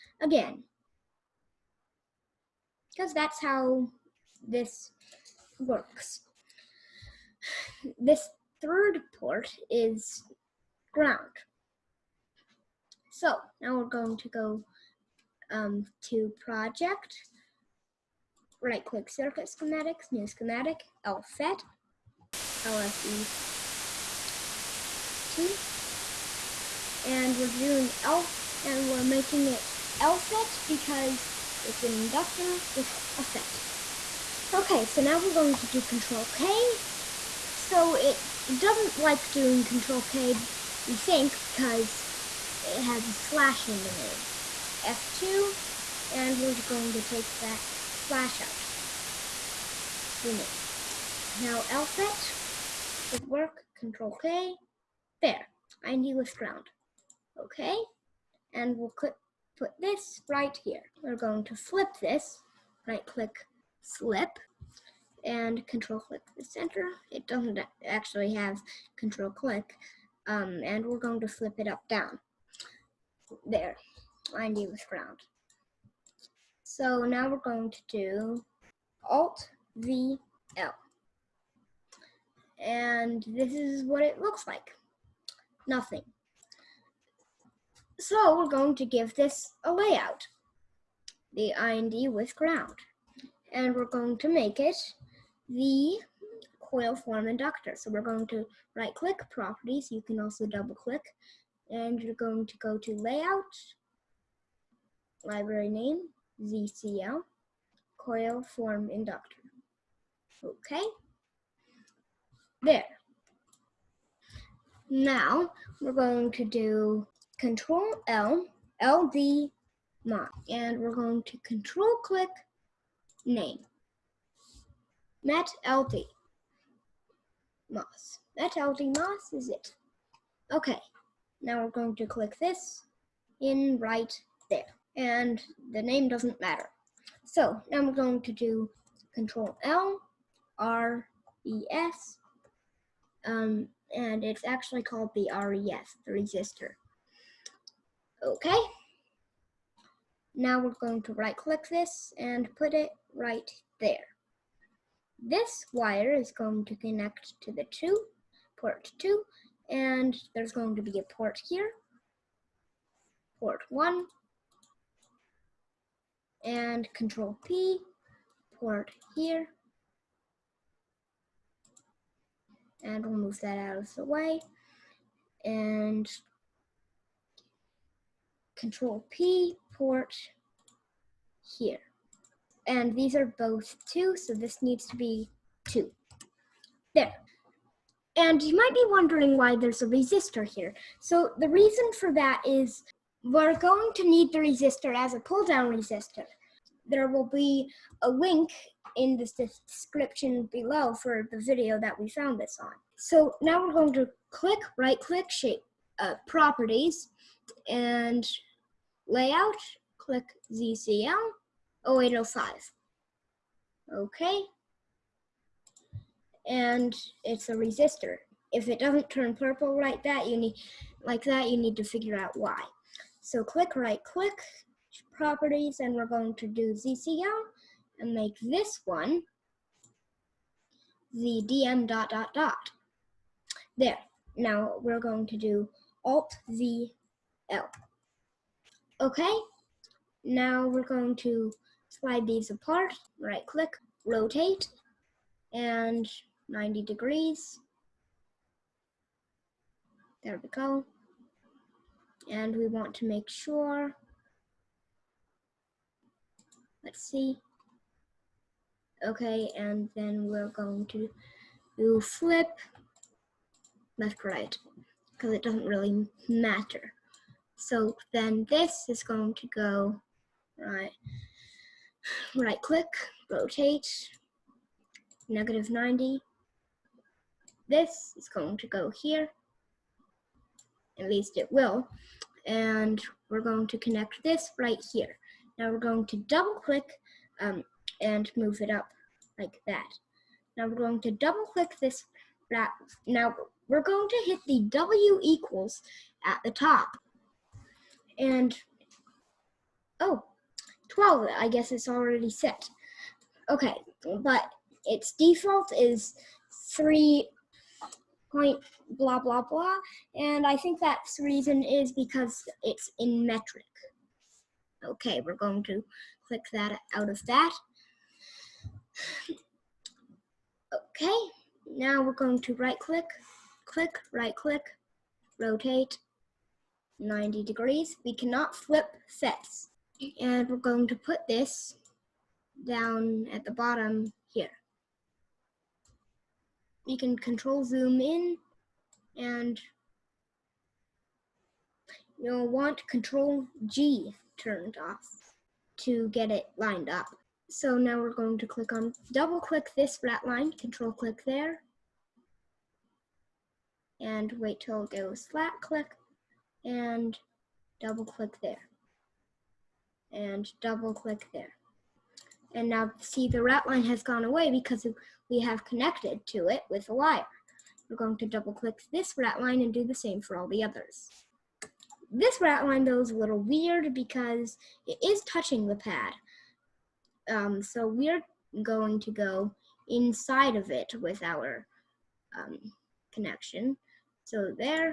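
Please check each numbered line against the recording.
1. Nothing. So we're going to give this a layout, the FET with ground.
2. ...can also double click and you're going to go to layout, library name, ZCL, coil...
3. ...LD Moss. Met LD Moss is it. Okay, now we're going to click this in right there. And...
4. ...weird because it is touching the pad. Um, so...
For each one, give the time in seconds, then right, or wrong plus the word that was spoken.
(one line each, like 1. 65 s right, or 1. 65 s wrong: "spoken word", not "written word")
1. 85 s wrong: "IND", not "FET"
2. 100 s right
3. 125 s right
4. 373 s right.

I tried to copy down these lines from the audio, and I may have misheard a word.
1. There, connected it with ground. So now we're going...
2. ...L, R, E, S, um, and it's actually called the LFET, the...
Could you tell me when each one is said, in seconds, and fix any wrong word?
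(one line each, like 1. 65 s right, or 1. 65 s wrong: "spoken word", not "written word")
1. 73 s wrong: "lined", not "connected"
2. 139 s wrong: "RES", not "LFET".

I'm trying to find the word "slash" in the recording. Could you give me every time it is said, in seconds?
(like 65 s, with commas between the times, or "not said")
43 s, 47 s.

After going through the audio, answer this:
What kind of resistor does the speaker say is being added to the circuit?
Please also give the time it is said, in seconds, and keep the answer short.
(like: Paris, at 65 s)
pull down resistor, at 195 s.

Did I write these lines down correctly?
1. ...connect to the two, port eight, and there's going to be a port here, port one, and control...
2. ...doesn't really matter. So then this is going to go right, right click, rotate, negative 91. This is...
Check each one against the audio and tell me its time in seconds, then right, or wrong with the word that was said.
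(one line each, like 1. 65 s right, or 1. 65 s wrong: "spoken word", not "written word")
1. 156 s wrong: "two", not "eight"
2. 265 s wrong: "90", not "91".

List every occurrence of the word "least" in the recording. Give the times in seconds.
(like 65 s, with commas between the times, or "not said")
281 s.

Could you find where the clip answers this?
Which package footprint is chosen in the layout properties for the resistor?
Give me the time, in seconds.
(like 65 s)
210 s.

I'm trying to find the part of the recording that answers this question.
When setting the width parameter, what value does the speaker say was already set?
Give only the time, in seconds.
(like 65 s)
300 s.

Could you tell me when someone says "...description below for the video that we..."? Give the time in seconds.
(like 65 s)
199 s.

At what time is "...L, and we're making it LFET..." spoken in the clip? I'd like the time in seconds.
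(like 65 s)
28 s.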